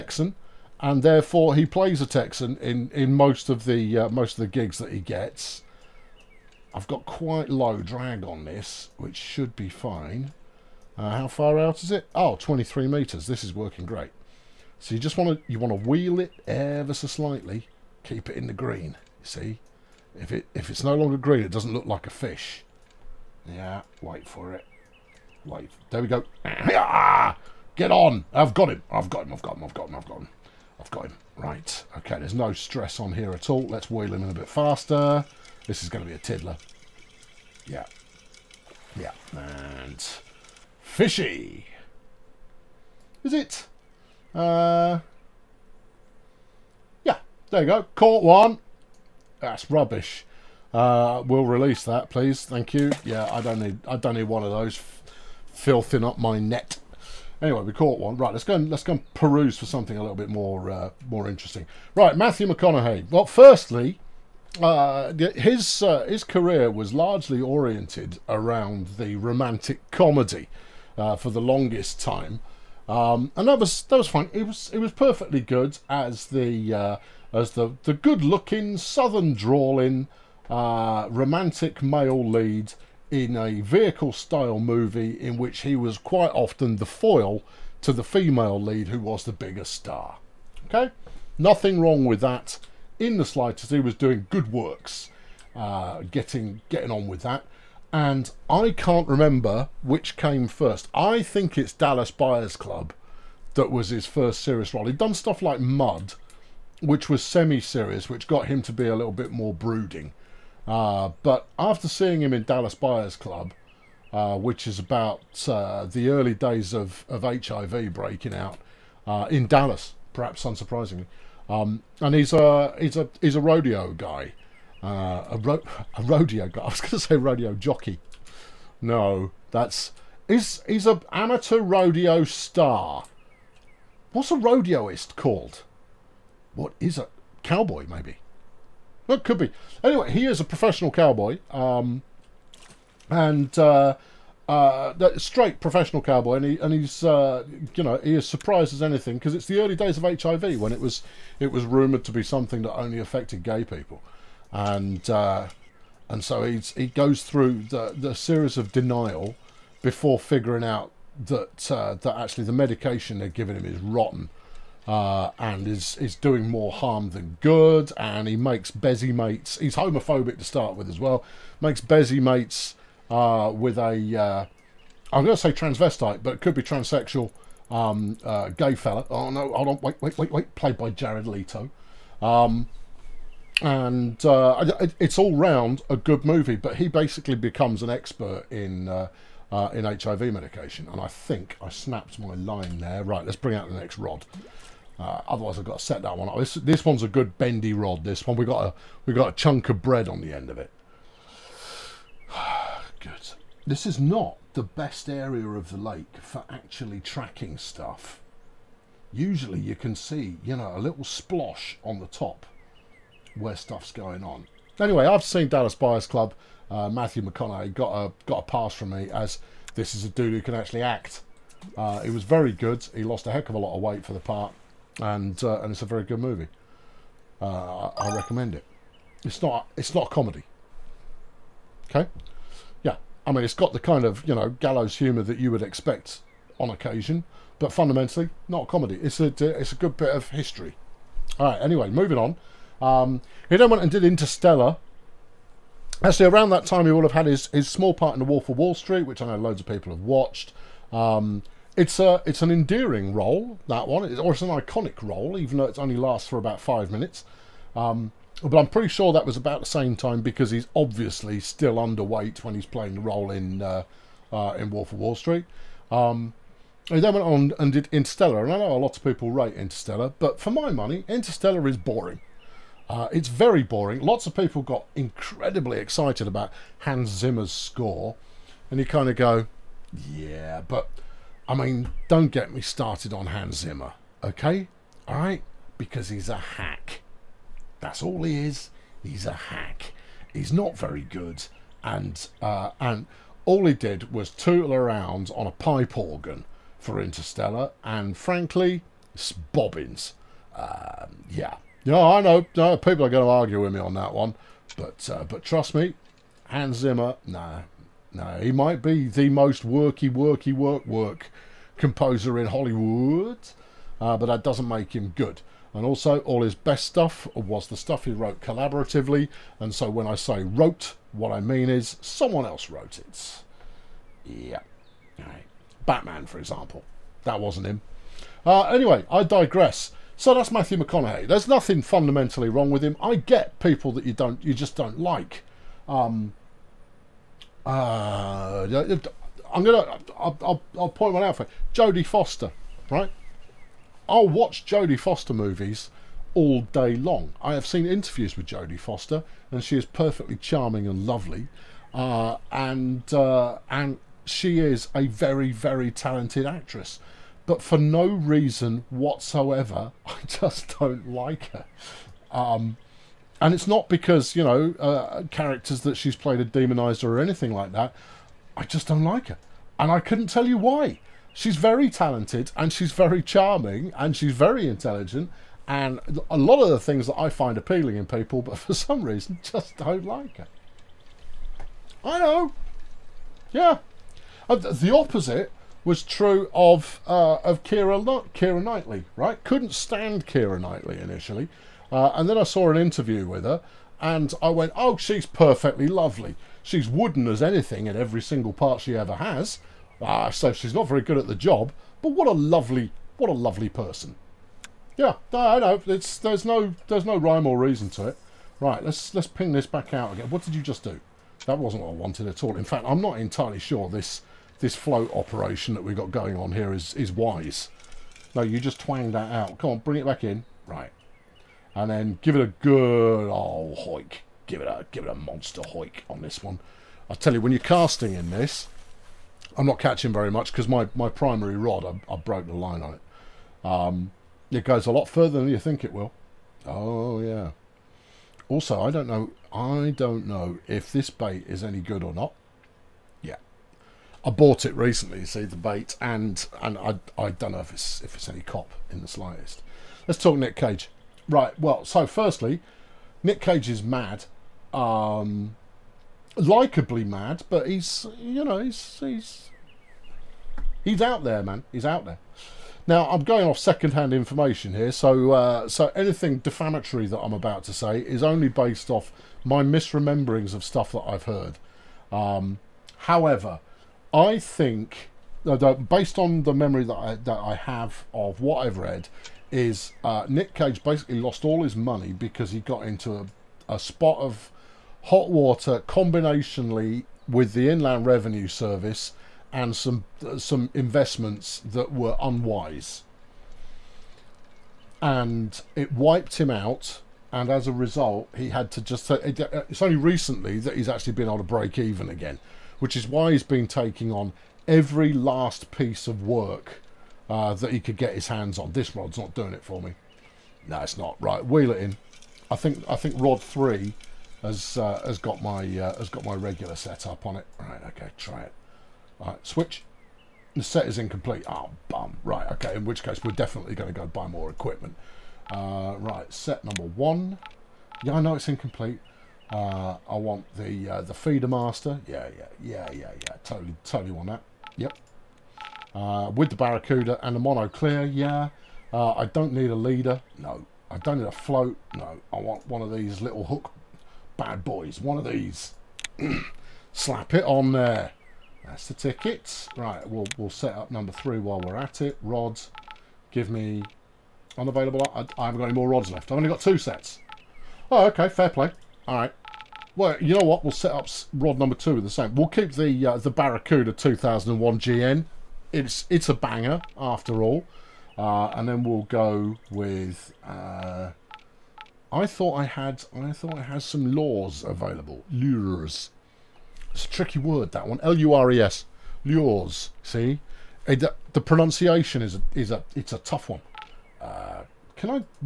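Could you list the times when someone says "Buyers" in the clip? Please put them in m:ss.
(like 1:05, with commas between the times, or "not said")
1:42, 1:52, 3:35.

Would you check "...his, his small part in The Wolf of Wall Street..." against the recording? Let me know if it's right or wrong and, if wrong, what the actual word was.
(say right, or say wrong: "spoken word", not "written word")
right.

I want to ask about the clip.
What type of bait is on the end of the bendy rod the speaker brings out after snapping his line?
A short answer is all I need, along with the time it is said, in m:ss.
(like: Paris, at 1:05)
bread, at 3:19.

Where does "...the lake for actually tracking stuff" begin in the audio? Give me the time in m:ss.
3:25.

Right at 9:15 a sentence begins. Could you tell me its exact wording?
I, I haven't got any more rods left.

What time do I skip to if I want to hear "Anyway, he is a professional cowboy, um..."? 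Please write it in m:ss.
2:19.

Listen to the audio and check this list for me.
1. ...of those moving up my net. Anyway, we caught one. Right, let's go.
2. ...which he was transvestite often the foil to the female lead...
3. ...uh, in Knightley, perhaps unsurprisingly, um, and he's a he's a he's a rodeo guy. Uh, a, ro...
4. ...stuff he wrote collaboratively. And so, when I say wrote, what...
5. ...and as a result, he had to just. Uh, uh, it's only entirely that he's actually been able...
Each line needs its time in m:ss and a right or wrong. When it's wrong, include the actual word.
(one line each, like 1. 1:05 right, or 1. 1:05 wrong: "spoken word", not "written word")
1. 0:54 wrong: "filthing", not "moving"
2. 1:25 wrong: "quite", not "transvestite"
3. 1:59 wrong: "Dallas", not "Knightley"
4. 5:17 right
5. 8:17 wrong: "recently", not "entirely".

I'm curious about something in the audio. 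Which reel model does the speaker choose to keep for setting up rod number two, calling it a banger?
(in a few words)
Barracuda 2001 GN.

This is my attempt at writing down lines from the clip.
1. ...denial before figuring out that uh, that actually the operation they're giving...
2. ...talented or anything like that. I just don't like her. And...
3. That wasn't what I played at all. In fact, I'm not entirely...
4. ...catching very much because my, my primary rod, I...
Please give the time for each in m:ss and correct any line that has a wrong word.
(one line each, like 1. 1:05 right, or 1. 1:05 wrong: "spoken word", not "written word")
1. 2:38 wrong: "medication", not "operation"
2. 6:06 wrong: "demonized", not "talented"
3. 6:51 wrong: "wanted", not "played"
4. 7:09 right.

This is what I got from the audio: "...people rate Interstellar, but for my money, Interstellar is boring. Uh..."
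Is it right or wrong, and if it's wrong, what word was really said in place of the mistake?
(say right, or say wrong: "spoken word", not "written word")
right.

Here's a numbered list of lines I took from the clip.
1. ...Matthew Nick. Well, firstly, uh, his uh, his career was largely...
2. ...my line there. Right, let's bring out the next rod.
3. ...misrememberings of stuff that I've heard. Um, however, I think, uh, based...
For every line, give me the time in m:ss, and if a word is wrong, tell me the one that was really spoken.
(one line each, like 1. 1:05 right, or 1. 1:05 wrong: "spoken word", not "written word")
1. 1:02 wrong: "McConaughey", not "Nick"
2. 3:12 right
3. 7:49 right.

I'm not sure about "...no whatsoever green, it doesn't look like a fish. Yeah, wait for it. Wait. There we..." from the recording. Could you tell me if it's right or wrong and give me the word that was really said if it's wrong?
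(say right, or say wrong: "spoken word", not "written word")
wrong: "longer", not "whatsoever".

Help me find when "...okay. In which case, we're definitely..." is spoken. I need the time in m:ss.
8:42.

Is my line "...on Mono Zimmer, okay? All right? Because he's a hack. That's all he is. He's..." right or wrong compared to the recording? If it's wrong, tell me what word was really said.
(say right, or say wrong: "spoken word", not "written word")
wrong: "Hans", not "Mono".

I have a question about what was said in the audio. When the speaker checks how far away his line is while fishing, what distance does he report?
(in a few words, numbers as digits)
23 metres.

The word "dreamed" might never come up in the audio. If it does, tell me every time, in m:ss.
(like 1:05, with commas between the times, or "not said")
not said.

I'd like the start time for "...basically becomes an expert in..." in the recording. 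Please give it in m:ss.
3:06.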